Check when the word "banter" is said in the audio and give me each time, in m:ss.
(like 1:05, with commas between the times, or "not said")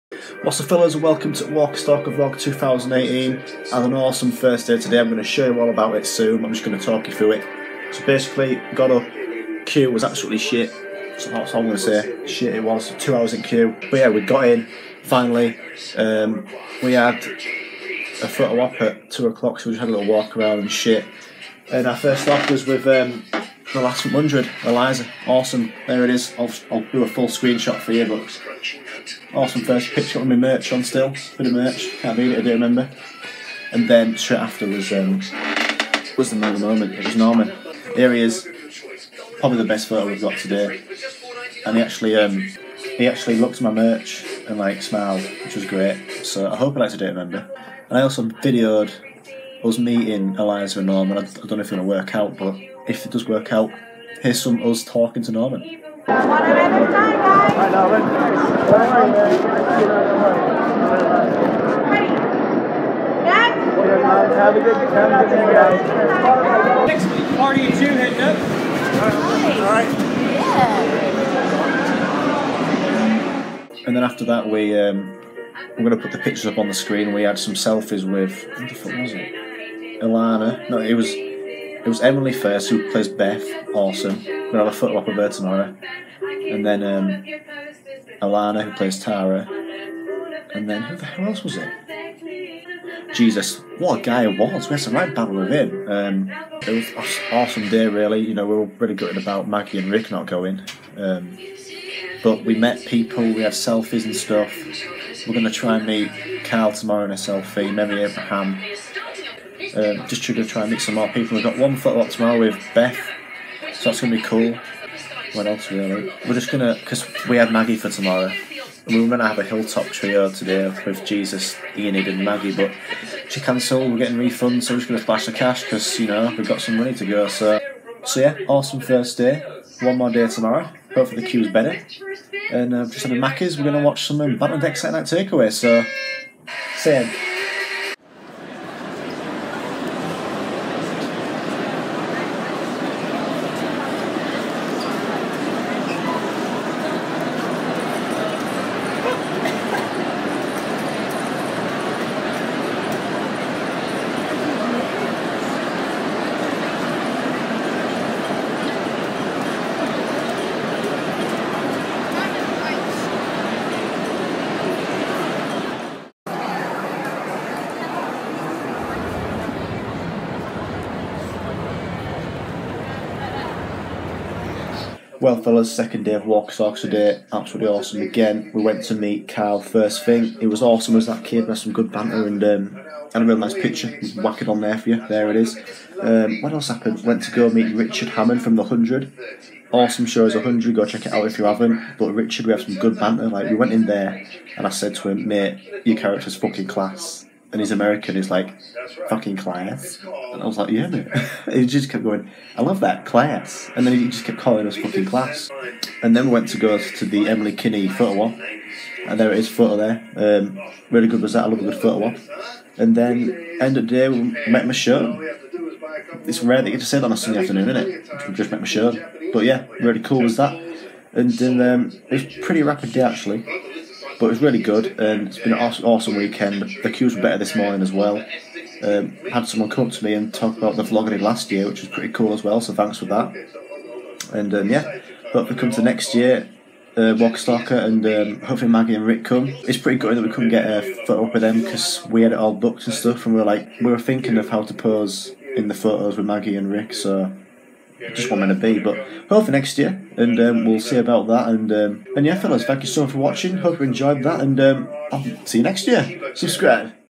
3:01, 3:12.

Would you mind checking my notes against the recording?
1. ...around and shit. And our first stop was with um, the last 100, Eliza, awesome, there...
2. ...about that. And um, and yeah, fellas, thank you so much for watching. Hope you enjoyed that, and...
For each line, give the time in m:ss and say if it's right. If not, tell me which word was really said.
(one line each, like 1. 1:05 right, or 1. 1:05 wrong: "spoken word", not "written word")
1. 0:20 right
2. 4:10 right.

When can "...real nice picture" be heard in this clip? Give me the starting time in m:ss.
3:03.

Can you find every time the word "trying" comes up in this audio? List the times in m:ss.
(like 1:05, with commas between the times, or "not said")
1:50.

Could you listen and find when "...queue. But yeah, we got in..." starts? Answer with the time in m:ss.
0:13.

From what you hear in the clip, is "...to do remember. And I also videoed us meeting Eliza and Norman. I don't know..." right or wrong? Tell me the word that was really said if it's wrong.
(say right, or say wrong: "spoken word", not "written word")
right.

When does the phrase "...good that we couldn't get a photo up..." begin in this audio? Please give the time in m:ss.
3:59.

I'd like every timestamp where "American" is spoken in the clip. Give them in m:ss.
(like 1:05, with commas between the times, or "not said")
3:17.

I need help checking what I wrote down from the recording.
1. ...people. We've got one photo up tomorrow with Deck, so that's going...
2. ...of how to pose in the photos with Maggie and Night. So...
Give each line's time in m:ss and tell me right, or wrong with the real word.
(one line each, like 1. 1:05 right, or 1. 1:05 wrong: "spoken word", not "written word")
1. 1:51 wrong: "Beth", not "Deck"
2. 4:04 wrong: "Rick", not "Night".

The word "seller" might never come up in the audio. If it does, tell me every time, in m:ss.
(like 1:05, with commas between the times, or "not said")
not said.